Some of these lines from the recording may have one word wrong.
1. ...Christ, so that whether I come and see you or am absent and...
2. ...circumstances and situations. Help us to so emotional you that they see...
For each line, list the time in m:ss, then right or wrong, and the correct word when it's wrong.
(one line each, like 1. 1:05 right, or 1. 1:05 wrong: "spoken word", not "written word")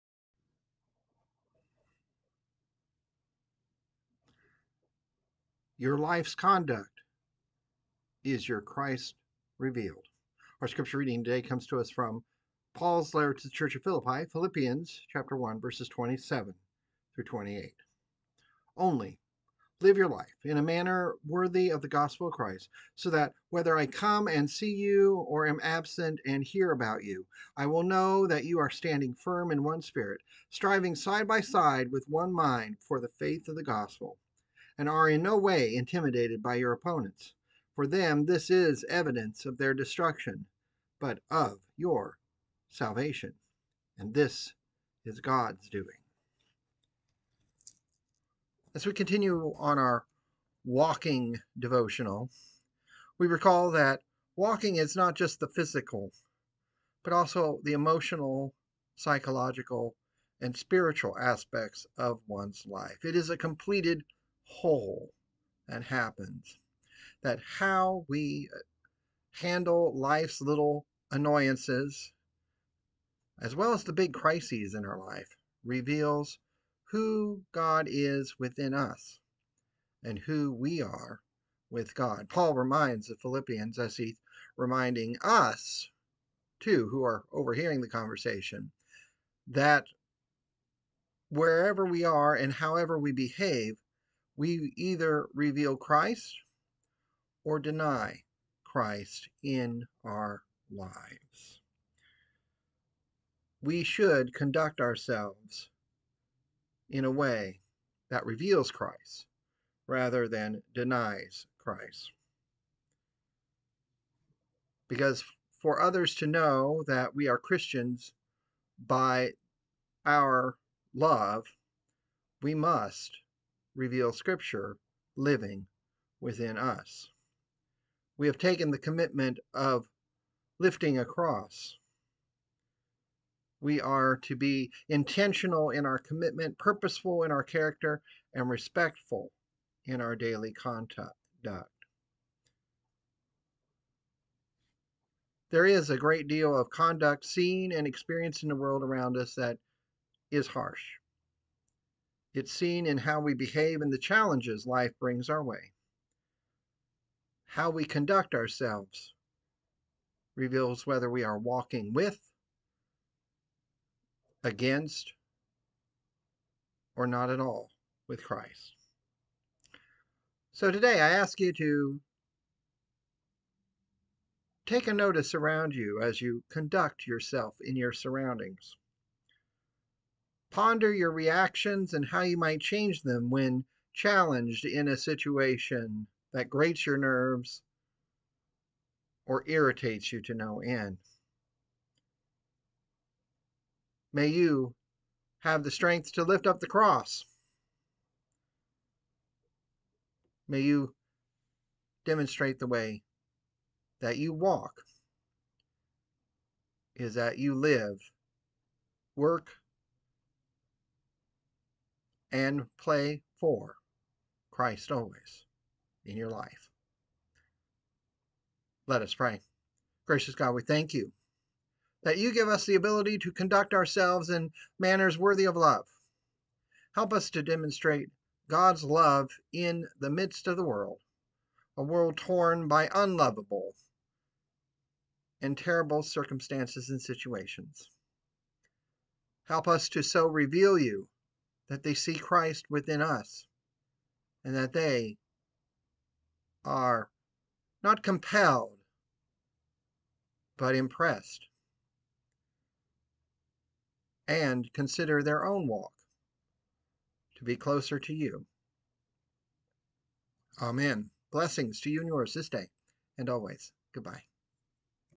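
1. 0:22 right
2. 3:56 wrong: "reveal", not "emotional".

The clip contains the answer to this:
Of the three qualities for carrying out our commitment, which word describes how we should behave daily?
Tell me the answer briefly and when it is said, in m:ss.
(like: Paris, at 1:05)
Respectful, at 2:18.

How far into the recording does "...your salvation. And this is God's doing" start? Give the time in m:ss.
0:41.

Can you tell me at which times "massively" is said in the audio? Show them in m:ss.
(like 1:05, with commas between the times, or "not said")
not said.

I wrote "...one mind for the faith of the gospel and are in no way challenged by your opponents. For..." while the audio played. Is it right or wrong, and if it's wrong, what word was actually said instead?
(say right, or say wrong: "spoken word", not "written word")
wrong: "intimidated", not "challenged".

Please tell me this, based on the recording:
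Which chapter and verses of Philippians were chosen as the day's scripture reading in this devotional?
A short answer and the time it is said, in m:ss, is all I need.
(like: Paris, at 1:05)
Chapter 1, verses 27-28, at 0:15.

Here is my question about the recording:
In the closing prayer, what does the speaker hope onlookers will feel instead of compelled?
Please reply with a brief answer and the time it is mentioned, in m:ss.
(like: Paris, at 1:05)
Impressed, at 4:10.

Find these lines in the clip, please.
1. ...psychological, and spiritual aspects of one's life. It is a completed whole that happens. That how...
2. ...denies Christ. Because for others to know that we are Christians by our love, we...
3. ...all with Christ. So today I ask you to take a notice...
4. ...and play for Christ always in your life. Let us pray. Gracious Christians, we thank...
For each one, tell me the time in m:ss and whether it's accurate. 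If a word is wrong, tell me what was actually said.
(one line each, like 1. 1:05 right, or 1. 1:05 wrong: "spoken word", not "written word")
1. 0:58 right
2. 1:50 right
3. 2:47 right
4. 3:32 wrong: "God", not "Christians".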